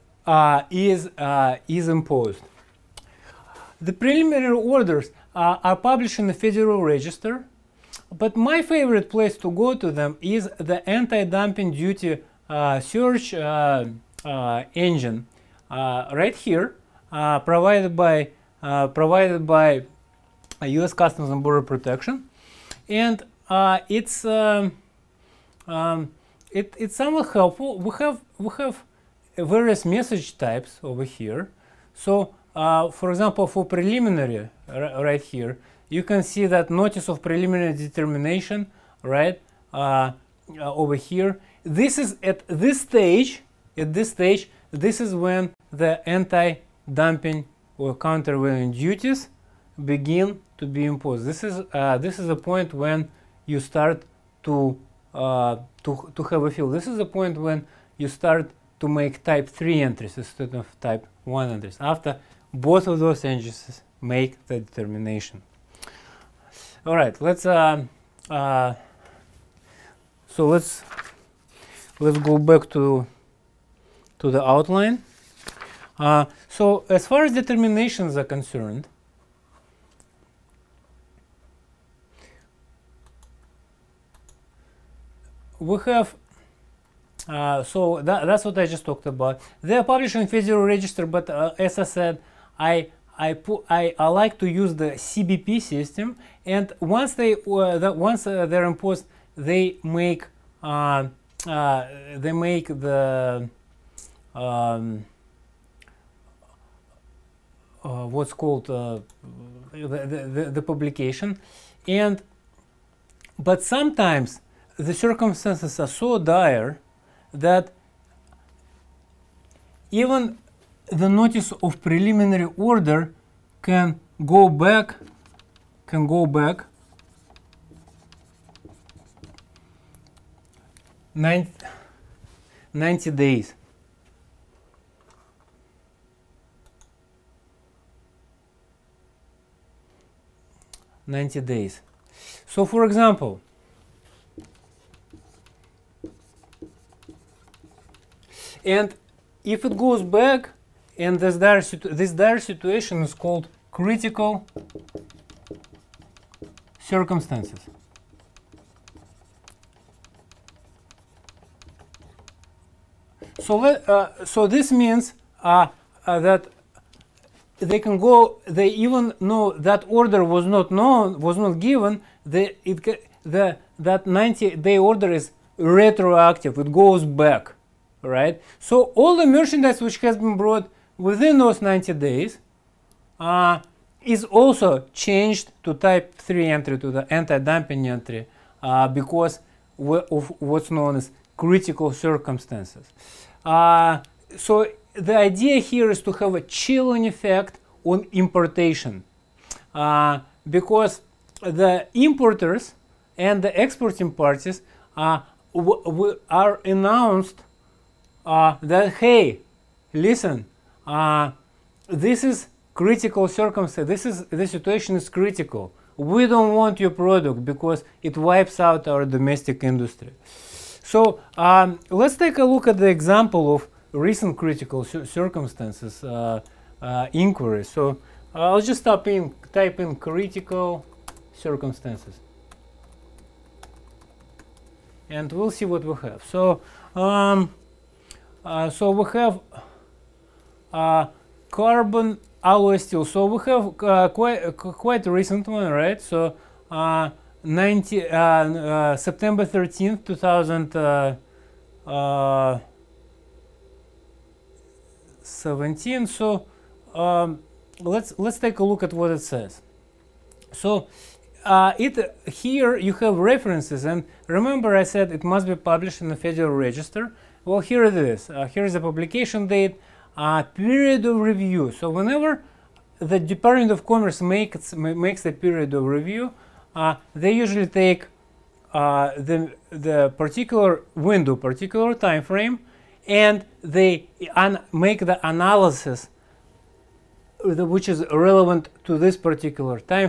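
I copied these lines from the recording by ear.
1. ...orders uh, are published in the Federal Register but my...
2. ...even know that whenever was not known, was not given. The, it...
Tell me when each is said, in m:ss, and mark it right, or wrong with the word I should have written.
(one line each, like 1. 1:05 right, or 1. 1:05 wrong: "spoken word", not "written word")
1. 0:04 right
2. 2:48 wrong: "order", not "whenever".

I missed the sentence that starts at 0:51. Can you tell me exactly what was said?
This is, uh, this is a point when you start to, uh, to, to have a feel.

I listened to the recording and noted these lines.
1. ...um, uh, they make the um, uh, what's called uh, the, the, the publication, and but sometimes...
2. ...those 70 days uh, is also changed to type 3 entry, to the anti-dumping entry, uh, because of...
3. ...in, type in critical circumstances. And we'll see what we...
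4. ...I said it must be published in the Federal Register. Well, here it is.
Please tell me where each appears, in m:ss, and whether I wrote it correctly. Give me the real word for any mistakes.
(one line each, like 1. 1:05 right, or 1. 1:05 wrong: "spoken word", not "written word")
1. 1:40 right
2. 3:01 wrong: "90", not "70"
3. 3:49 right
4. 4:24 right.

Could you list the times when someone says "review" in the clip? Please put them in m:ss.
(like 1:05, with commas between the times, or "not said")
4:31, 4:35.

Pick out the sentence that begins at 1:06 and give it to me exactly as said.
All right, let's um, uh, so let's let's go back to to the outline.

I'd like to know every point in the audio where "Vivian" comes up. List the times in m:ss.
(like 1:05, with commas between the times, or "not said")
not said.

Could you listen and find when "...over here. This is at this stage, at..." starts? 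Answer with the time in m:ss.
0:40.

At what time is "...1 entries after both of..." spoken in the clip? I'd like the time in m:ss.
1:01.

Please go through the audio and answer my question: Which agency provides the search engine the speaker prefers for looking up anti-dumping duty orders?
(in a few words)
U.S. Customs and Border Protection.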